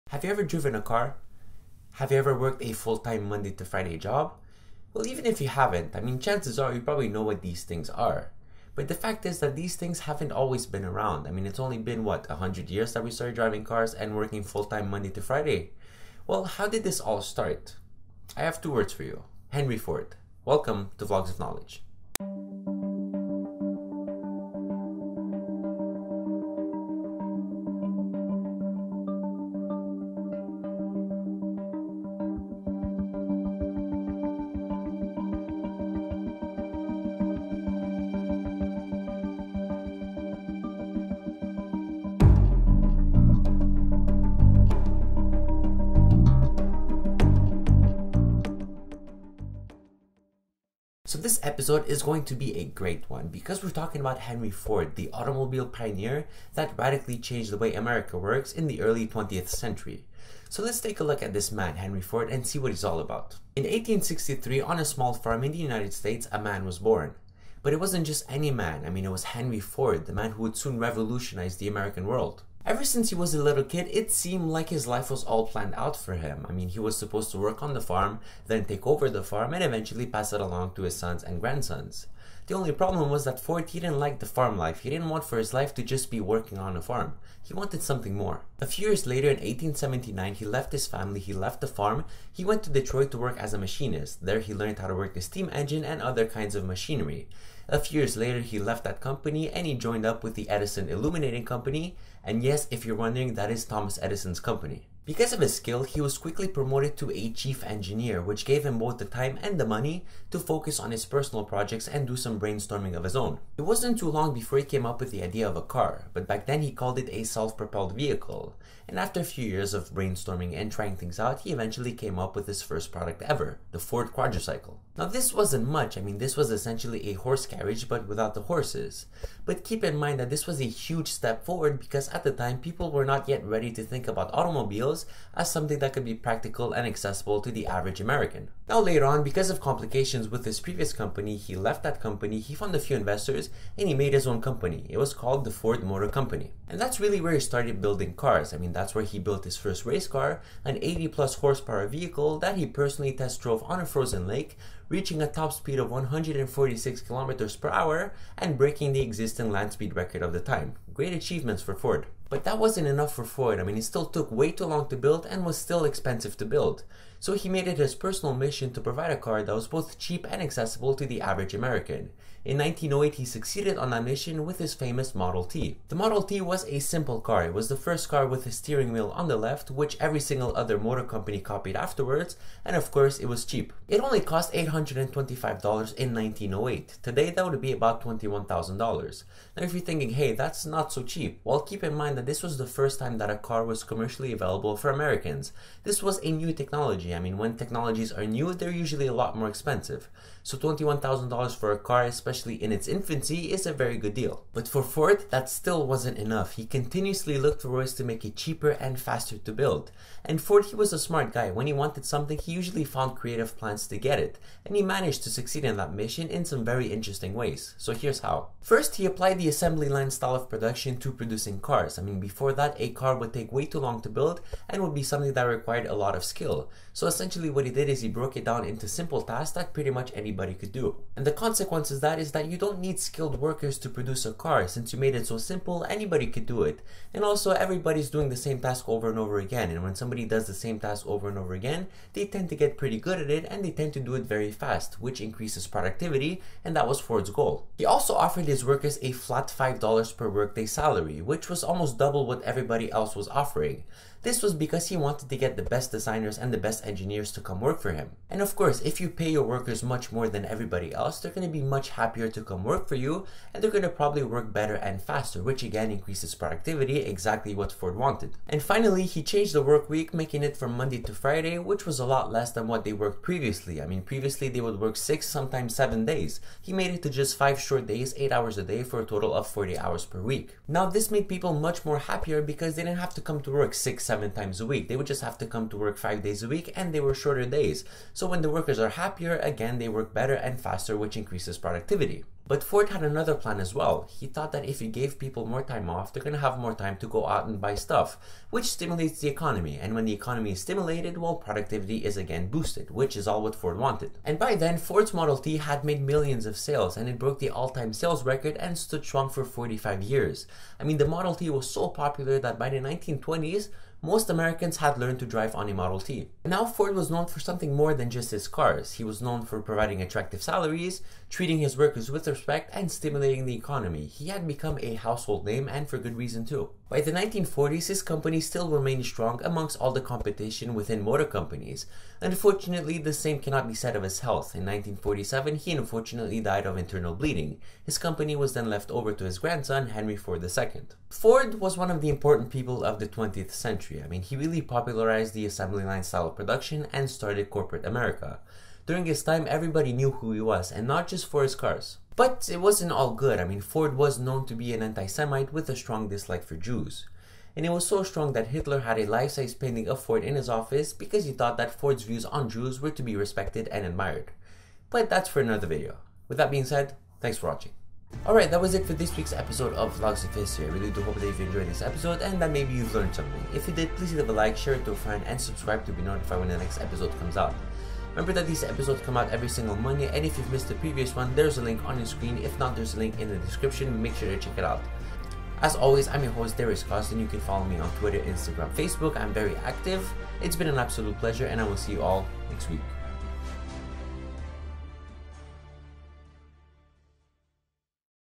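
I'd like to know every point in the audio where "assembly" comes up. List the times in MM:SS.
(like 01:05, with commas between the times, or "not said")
03:39, 05:45.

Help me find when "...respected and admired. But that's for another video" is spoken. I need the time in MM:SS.
06:03.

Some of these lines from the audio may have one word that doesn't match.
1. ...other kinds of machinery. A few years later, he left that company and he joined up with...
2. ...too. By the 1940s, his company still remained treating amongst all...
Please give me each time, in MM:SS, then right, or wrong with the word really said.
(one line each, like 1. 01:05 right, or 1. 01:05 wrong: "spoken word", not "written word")
1. 01:36 right
2. 05:26 wrong: "strong", not "treating".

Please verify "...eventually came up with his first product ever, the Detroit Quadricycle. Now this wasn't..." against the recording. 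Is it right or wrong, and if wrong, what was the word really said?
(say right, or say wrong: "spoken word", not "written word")
wrong: "Ford", not "Detroit".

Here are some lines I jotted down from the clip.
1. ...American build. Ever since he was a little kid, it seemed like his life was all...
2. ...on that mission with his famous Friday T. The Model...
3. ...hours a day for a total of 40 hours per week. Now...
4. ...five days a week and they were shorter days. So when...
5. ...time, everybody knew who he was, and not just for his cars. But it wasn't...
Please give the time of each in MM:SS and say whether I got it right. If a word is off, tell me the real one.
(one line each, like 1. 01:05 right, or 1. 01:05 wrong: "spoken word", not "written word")
1. 01:11 wrong: "world", not "build"
2. 02:53 wrong: "Model", not "Friday"
3. 04:38 right
4. 04:45 right
5. 05:49 right.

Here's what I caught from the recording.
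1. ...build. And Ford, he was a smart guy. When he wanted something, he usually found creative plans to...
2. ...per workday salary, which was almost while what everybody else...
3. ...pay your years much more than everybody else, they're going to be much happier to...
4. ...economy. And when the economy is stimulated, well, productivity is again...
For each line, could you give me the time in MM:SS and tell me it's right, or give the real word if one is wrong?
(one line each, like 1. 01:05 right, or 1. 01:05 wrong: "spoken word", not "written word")
1. 03:29 right
2. 04:10 wrong: "double", not "while"
3. 04:19 wrong: "workers", not "years"
4. 04:59 right.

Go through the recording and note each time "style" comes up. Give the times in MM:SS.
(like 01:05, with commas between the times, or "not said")
03:40, 05:46.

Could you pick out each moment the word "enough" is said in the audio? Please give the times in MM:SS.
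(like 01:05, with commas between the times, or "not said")
02:42, 03:26.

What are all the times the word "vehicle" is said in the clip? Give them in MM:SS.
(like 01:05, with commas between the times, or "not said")
01:57, 02:31.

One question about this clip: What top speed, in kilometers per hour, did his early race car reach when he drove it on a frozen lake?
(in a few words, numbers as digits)
146.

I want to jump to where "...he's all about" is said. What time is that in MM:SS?
01:02.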